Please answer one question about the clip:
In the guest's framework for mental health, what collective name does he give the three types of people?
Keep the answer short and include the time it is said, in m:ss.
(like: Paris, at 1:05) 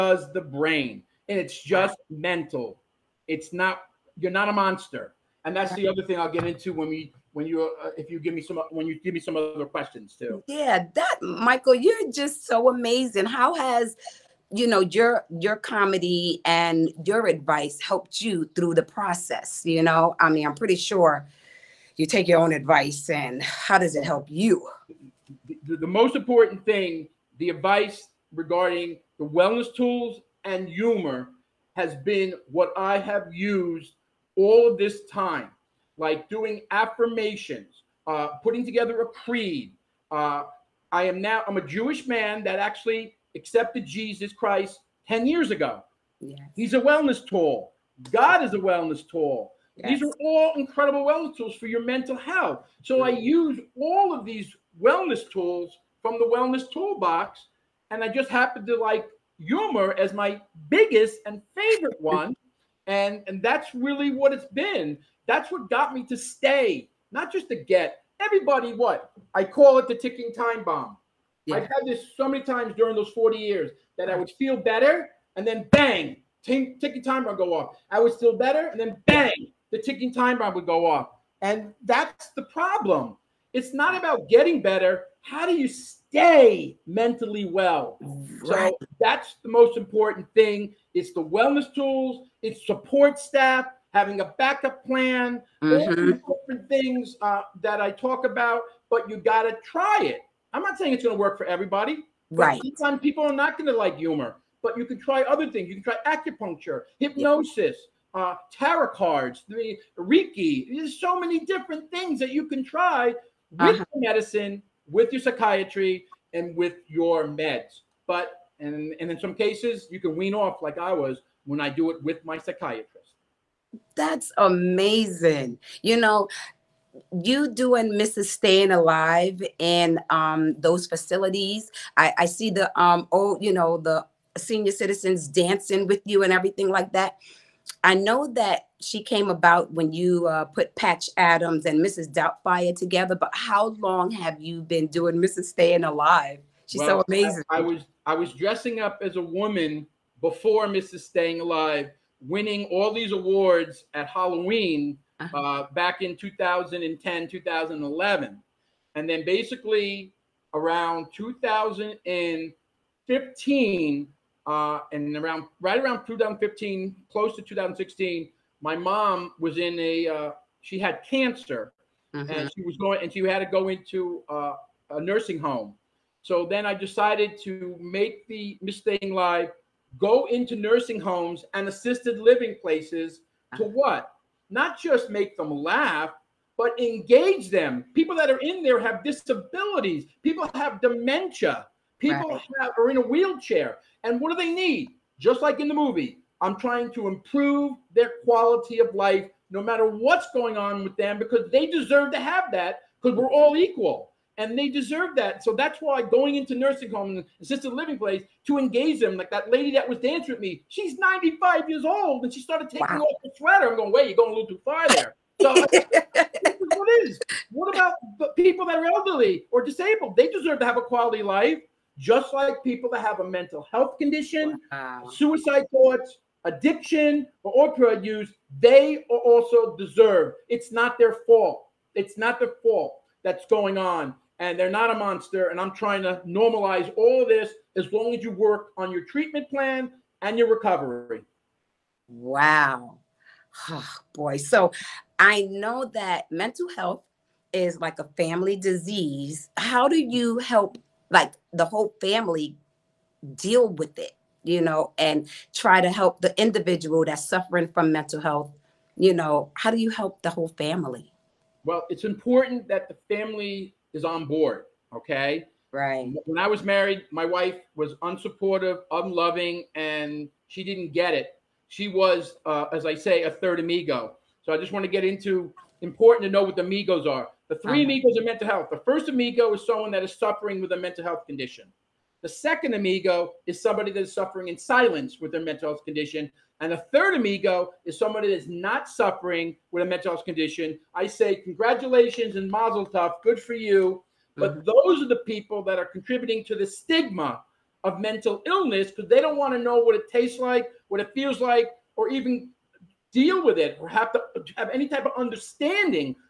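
three amigos, at 4:37.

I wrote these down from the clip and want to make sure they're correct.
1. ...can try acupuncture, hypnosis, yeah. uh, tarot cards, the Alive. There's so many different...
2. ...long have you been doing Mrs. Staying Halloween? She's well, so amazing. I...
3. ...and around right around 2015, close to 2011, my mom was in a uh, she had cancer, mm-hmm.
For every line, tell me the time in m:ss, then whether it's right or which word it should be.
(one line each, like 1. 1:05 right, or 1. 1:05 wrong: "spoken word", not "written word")
1. 1:45 wrong: "Reiki", not "Alive"
2. 2:23 wrong: "Alive", not "Halloween"
3. 2:44 wrong: "2016", not "2011".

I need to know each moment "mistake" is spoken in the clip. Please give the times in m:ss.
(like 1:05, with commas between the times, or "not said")
2:58.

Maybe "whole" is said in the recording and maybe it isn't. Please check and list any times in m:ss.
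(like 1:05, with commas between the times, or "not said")
4:11, 4:20.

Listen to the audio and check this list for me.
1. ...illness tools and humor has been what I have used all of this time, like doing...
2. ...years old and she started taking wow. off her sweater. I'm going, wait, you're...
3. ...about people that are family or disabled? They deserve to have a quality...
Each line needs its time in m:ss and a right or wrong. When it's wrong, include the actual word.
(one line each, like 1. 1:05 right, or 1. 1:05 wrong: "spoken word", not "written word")
1. 0:29 wrong: "wellness", not "illness"
2. 3:31 right
3. 3:37 wrong: "elderly", not "family".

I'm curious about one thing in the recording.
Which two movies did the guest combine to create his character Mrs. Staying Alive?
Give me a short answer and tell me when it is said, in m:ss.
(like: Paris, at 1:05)
Patch Adams and Mrs. Doubtfire, at 2:20.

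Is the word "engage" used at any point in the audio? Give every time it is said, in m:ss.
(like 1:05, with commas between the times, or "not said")
3:06, 3:28.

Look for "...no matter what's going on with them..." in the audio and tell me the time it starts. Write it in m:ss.
3:19.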